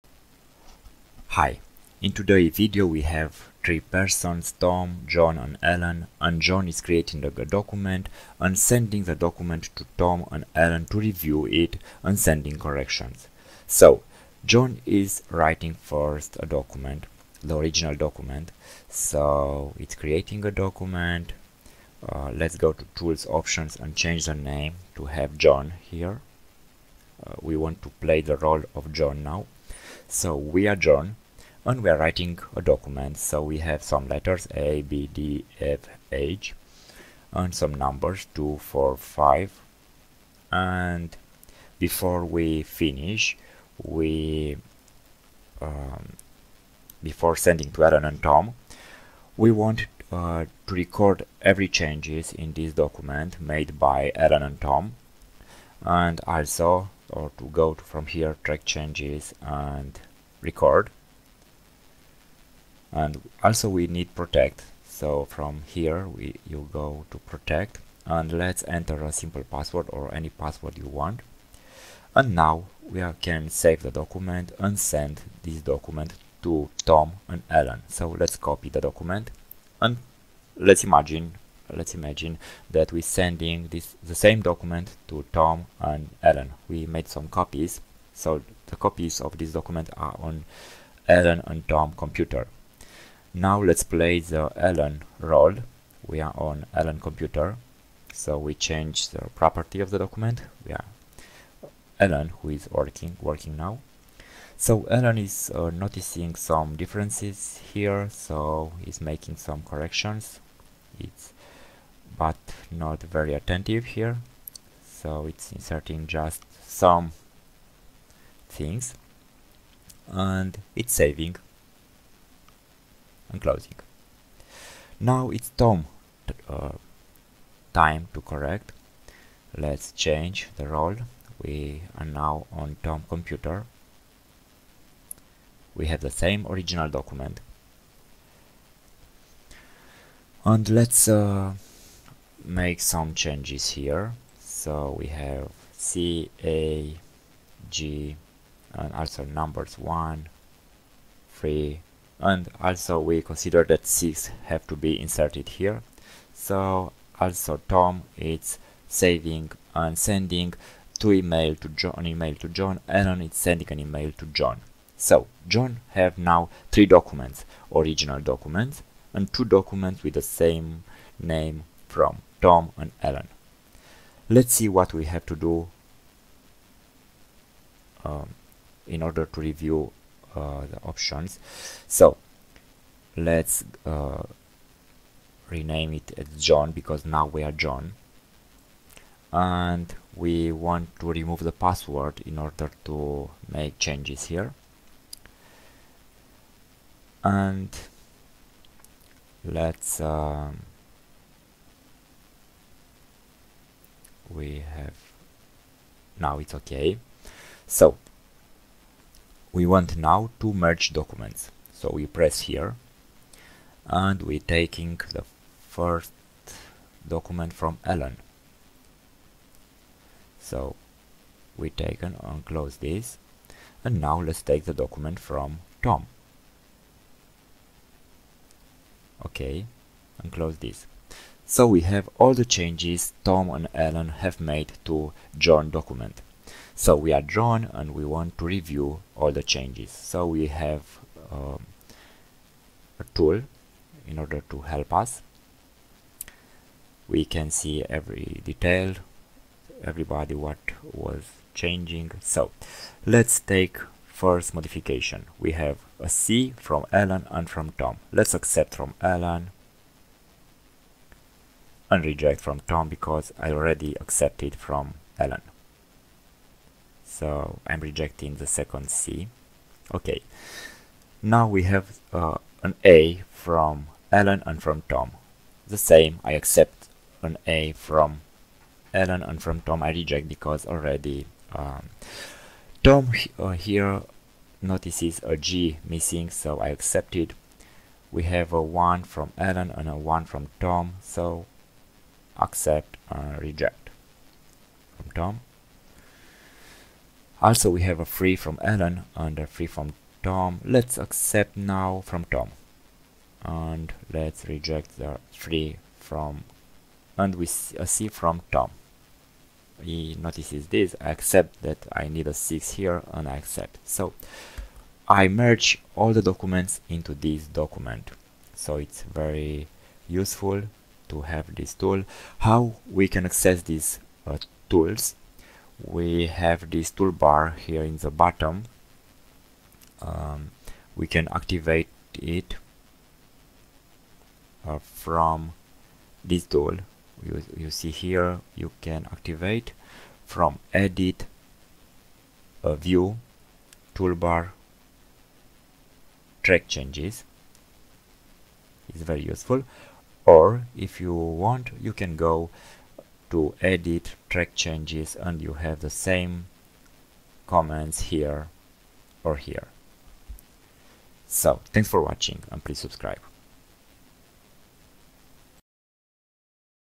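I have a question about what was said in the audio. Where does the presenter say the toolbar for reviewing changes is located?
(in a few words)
In the bottom.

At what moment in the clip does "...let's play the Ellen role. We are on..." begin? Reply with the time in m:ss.
1:33.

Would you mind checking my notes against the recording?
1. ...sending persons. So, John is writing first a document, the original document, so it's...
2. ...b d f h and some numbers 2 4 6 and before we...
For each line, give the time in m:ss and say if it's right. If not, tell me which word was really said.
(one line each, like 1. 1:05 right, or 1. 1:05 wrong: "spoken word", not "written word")
1. 0:12 wrong: "corrections", not "persons"
2. 0:34 wrong: "5", not "6".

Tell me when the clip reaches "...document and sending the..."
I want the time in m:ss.
0:07.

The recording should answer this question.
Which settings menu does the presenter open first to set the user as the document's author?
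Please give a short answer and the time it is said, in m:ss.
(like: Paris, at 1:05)
Tools options, at 0:22.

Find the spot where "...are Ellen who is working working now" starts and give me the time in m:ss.
1:40.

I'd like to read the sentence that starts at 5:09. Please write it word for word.
He notices this, I accept that I need a 6 here and I accept.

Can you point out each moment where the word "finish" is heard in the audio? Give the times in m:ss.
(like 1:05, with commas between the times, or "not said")
0:42.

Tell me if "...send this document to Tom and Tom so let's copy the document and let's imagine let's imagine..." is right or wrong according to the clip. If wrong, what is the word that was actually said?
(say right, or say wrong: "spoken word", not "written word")
wrong: "Ellen", not "Tom".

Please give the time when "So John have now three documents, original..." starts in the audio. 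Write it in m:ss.
2:44.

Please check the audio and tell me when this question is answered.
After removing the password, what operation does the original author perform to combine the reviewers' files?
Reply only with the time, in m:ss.
3:30.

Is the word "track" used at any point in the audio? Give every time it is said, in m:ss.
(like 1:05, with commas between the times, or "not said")
0:58, 5:46, 5:54.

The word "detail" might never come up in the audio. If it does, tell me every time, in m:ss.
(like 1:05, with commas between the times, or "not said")
4:08.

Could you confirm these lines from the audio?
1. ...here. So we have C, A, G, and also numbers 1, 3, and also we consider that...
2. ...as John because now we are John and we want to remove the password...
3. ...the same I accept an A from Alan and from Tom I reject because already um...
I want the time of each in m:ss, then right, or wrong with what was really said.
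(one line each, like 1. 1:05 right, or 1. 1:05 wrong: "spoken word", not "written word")
1. 2:23 right
2. 3:06 right
3. 4:35 right.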